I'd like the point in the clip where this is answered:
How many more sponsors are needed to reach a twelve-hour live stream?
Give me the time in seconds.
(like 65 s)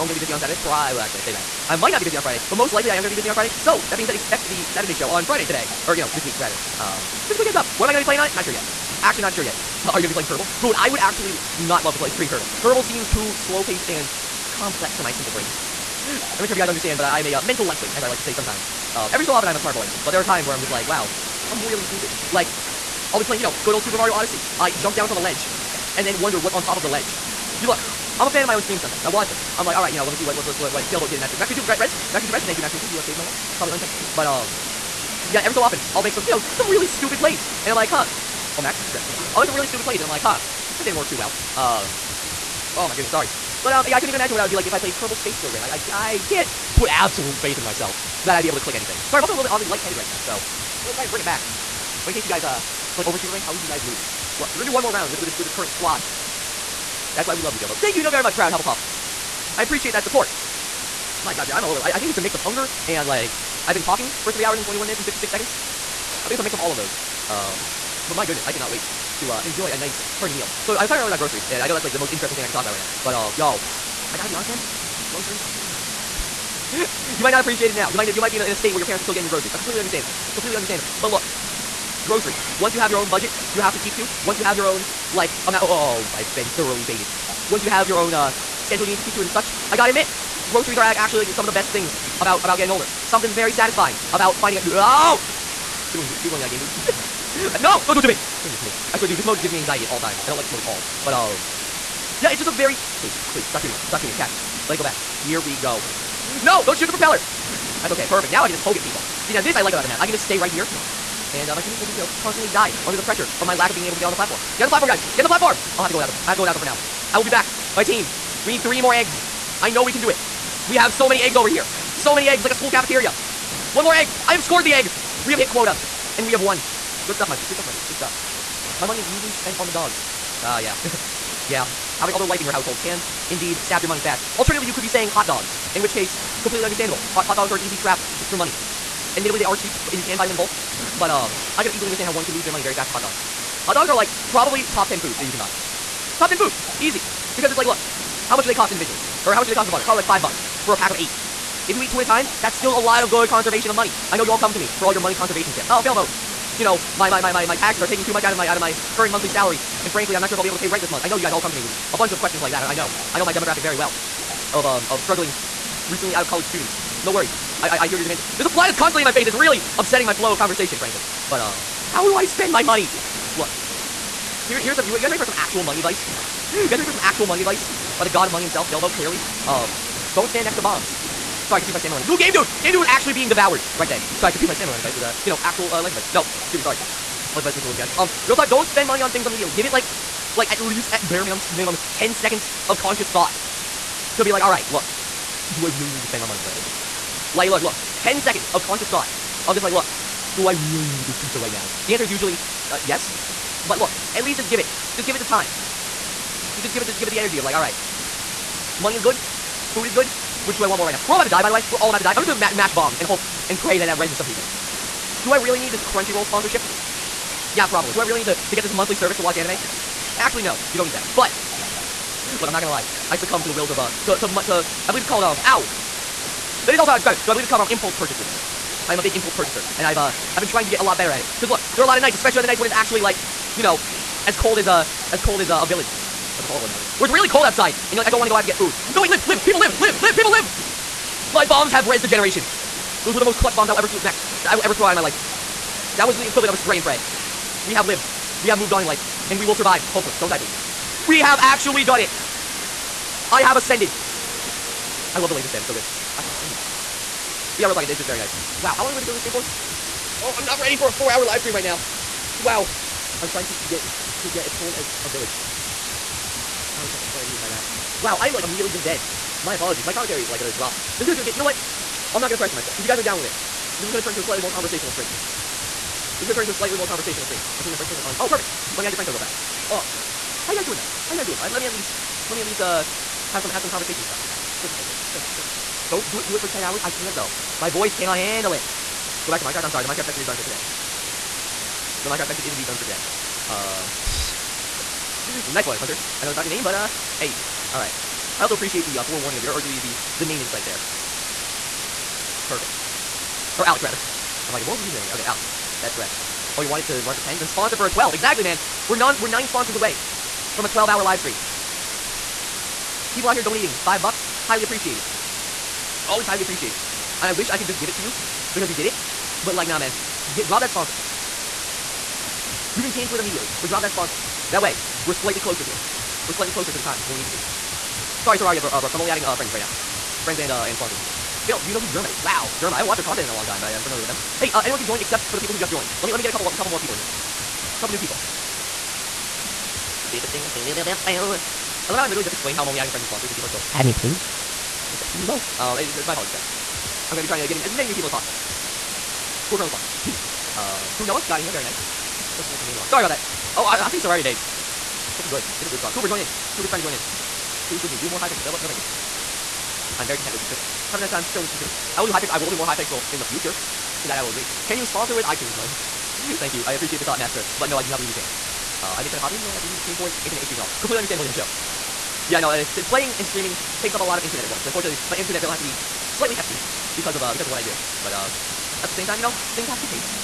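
309 s.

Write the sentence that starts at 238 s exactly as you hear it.
No, wait, live, live, people live, live, live, people live!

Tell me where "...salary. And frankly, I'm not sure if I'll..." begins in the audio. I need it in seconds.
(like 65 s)
159 s.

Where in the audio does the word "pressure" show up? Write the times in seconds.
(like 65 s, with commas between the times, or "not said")
113 s, 272 s.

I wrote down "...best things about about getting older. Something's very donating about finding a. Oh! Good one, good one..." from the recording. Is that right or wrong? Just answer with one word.
wrong.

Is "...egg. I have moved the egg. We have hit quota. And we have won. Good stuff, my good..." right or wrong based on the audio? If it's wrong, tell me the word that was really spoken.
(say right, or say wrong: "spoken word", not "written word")
wrong: "scored", not "moved".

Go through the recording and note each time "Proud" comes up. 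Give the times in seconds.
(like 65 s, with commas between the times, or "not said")
58 s.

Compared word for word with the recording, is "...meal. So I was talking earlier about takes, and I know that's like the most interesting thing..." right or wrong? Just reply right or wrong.
wrong.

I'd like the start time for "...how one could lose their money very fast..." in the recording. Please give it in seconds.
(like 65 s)
142 s.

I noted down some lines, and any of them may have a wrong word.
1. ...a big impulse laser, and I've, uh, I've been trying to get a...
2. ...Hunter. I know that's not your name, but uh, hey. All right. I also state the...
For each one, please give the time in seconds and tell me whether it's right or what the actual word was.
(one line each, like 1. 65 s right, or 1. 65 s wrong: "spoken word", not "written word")
1. 228 s wrong: "purchaser", not "laser"
2. 295 s wrong: "appreciate", not "state".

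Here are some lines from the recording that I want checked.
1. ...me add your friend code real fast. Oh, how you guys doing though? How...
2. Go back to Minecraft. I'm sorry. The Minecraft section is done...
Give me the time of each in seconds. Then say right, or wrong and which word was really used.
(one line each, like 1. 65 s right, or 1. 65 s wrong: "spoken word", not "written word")
1. 278 s right
2. 289 s right.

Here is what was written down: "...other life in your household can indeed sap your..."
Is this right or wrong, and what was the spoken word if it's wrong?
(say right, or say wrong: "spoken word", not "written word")
right.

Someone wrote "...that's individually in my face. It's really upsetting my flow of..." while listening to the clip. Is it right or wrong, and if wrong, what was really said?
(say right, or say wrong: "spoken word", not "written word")
wrong: "constantly", not "individually".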